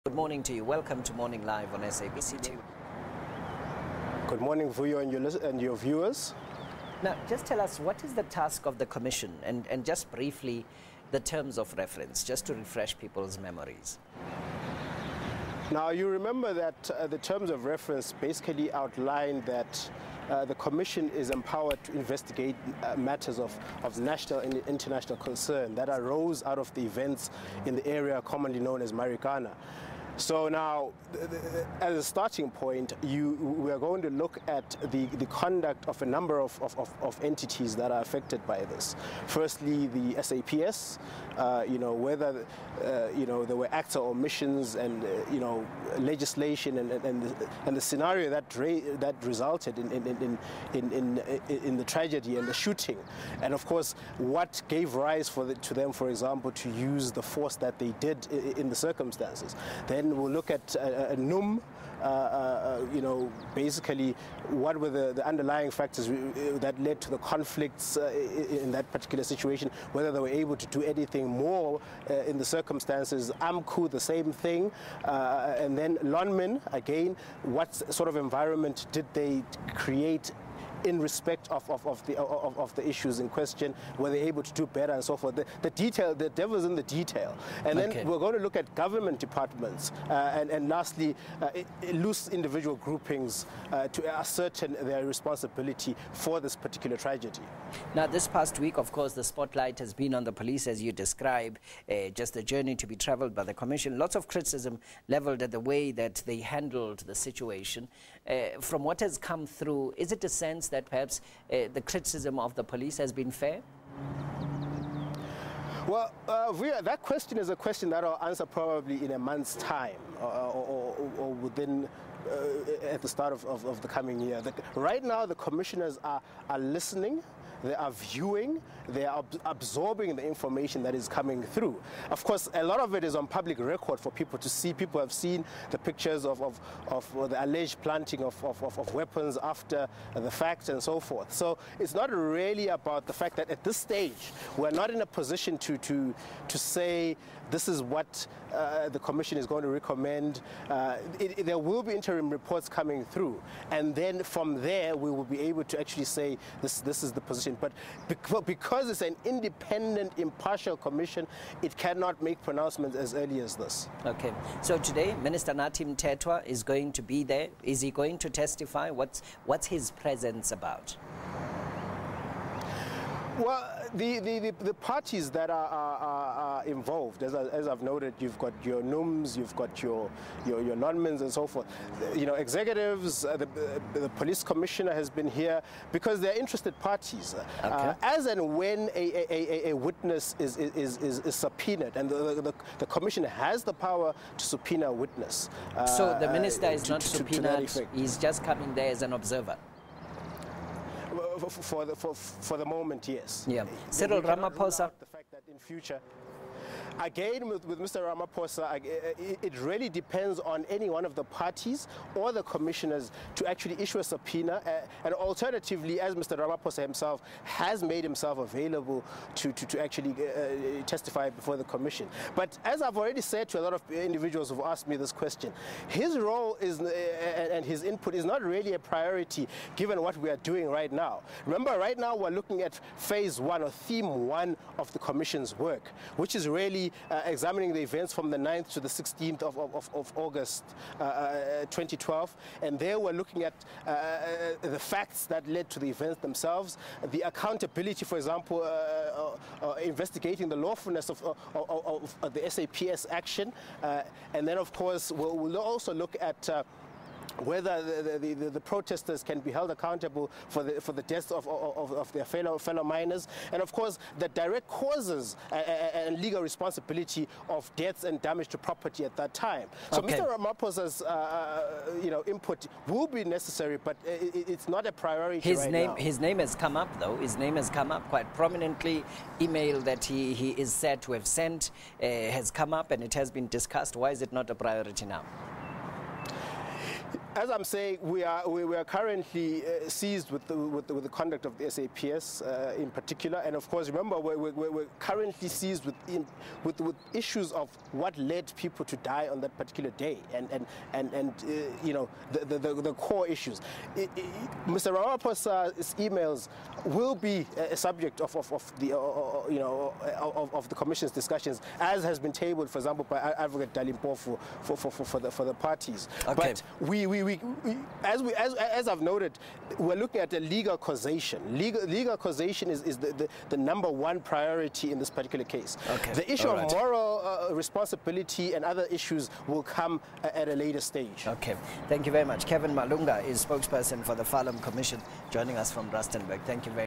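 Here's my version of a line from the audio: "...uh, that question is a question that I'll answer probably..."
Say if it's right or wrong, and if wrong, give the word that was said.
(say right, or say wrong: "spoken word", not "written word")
right.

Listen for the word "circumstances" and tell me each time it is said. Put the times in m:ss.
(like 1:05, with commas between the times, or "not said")
0:58, 1:12.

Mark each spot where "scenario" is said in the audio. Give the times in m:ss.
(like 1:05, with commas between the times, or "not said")
0:47.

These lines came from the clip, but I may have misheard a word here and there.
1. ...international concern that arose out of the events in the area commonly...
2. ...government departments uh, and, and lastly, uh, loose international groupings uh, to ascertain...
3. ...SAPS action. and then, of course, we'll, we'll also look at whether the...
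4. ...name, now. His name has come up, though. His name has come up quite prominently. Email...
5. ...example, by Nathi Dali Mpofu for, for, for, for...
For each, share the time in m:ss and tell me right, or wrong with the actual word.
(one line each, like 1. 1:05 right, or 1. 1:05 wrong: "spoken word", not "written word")
1. 0:24 right
2. 1:28 wrong: "individual", not "international"
3. 4:12 right
4. 4:35 right
5. 5:12 wrong: "Advocate", not "Nathi".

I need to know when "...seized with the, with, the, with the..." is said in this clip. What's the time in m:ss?
4:49.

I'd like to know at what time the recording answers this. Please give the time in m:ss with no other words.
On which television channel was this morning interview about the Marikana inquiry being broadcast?
0:01.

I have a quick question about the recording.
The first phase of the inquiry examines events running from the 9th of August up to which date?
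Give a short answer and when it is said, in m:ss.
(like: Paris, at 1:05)
16th of August, at 3:58.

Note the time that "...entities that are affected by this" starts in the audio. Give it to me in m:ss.
0:37.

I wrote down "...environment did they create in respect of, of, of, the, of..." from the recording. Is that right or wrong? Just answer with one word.
right.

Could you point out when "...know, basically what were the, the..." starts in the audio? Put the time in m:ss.
1:03.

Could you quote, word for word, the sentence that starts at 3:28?
Ramaphosa, it really depends on any one of the parties or the commissioners to actually issue a subpoena.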